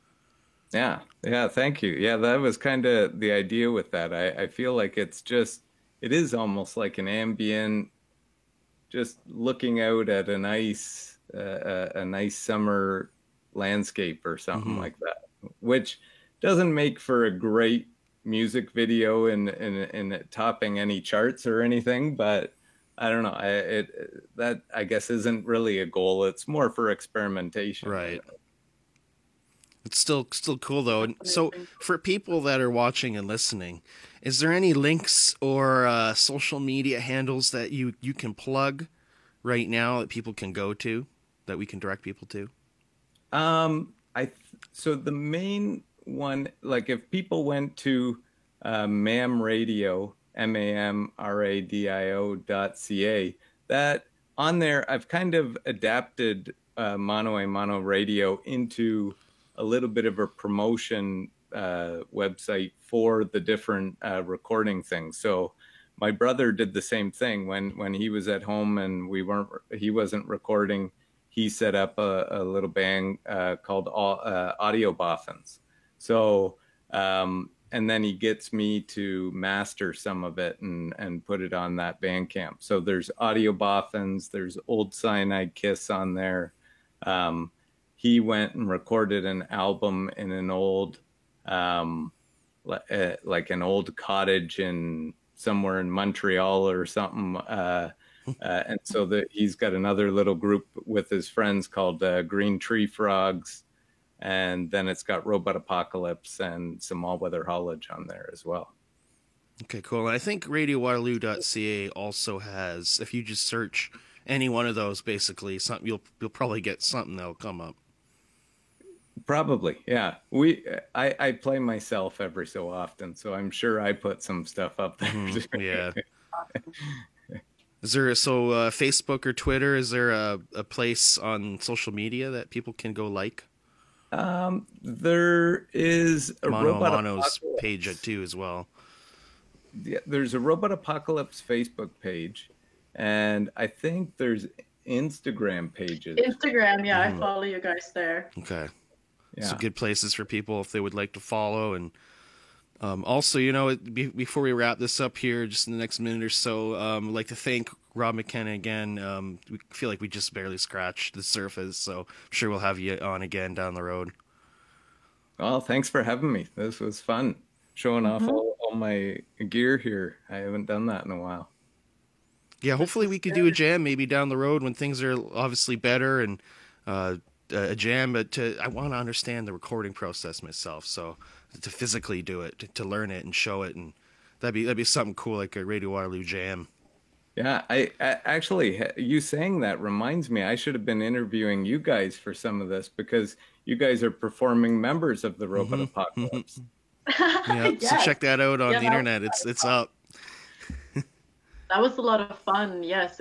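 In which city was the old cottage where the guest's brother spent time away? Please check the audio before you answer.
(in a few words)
Montreal.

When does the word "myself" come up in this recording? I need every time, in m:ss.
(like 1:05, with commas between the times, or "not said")
2:01, 3:00.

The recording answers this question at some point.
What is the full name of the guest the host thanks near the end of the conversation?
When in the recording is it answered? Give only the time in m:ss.
2:37.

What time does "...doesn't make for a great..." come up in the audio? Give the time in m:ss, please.
0:16.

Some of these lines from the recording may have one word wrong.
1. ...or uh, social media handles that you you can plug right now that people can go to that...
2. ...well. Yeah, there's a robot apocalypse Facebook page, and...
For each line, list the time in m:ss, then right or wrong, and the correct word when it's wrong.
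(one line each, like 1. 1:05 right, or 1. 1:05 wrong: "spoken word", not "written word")
1. 0:35 right
2. 2:18 right.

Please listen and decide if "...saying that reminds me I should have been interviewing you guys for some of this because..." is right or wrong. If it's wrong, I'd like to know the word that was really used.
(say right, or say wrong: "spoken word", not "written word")
right.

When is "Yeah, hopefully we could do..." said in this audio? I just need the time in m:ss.
2:52.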